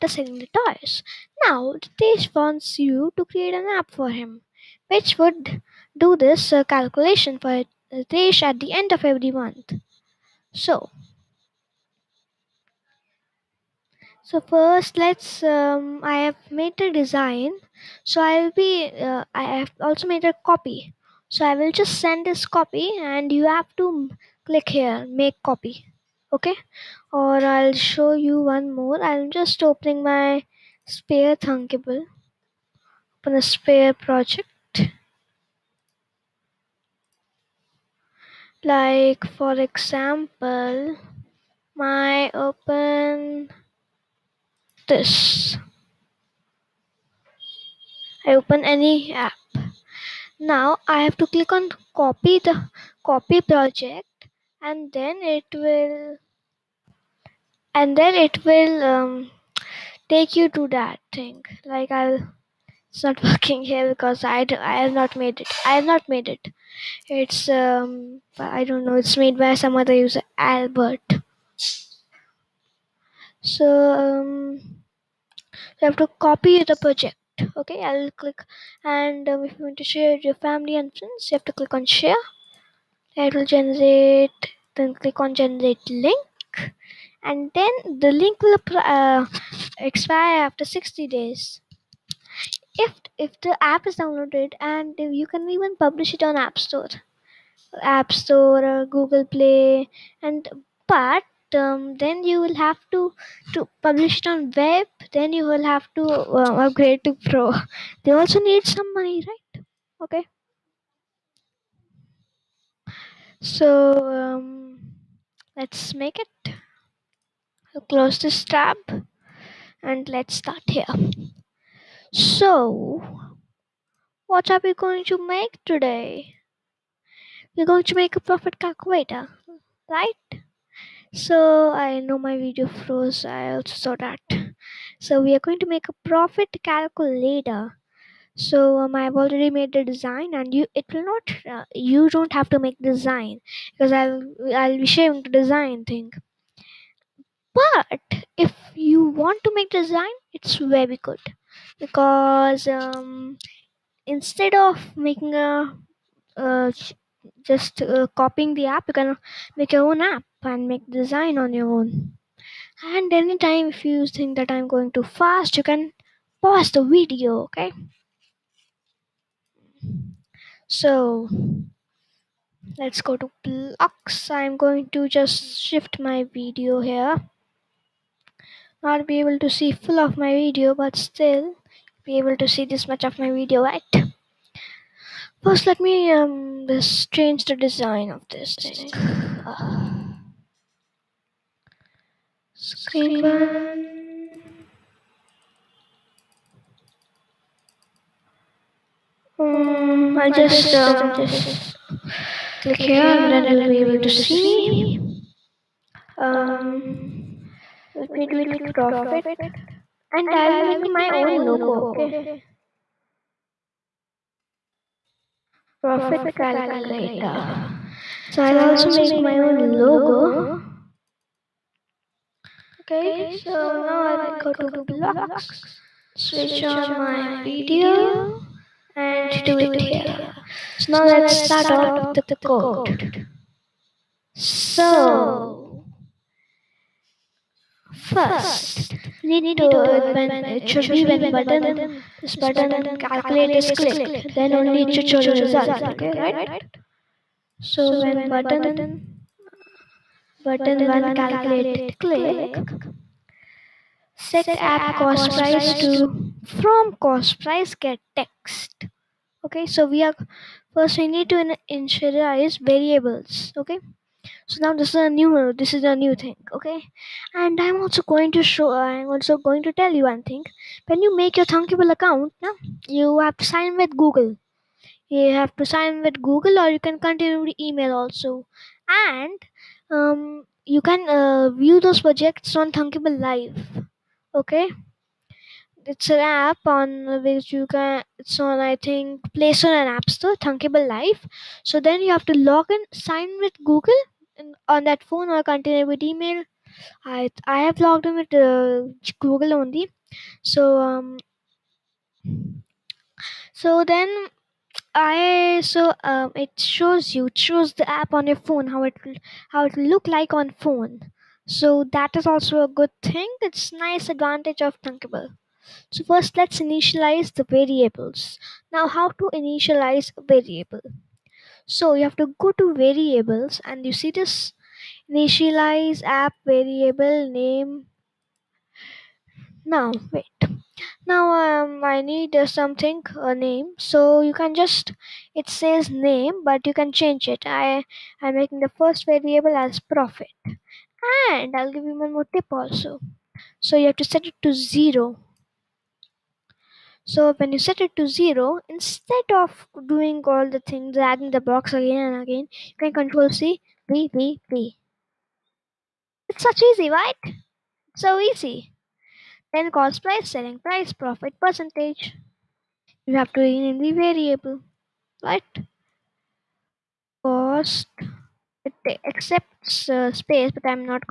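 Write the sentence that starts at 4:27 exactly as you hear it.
And I'm also going to show I'm also going to tell you one thing.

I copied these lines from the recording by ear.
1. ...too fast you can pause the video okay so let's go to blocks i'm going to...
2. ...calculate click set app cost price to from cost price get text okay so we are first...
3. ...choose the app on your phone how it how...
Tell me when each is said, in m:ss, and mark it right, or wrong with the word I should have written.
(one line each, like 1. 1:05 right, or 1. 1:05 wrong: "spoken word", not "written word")
1. 2:44 right
2. 4:11 right
3. 5:07 right.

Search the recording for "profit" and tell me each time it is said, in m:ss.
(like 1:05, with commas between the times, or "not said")
2:08, 2:16, 3:28, 3:35, 5:39, 6:00.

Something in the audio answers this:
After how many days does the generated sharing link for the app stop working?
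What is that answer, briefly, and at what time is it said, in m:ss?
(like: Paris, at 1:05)
60, at 1:30.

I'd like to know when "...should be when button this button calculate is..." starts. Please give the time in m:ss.
4:00.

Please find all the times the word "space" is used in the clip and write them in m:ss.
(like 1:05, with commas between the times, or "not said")
6:10.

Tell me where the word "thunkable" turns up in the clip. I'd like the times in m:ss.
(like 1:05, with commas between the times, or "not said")
0:31, 4:31, 4:42, 4:50, 5:14.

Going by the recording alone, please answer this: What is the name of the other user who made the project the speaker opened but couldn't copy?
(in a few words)
Albert.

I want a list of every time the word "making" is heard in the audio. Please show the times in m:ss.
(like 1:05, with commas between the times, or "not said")
2:34, 5:38.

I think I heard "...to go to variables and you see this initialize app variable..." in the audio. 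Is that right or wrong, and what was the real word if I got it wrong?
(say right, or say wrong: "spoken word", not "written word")
right.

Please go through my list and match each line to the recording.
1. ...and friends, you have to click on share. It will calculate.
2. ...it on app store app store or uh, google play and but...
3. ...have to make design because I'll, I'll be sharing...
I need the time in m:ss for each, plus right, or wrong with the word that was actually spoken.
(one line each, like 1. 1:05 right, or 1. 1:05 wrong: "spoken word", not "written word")
1. 1:20 wrong: "generate", not "calculate"
2. 1:36 right
3. 2:22 right.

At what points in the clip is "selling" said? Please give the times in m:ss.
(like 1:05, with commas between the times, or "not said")
0:00, 6:00.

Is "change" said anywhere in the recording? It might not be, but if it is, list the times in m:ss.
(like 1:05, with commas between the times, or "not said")
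3:07, 5:36.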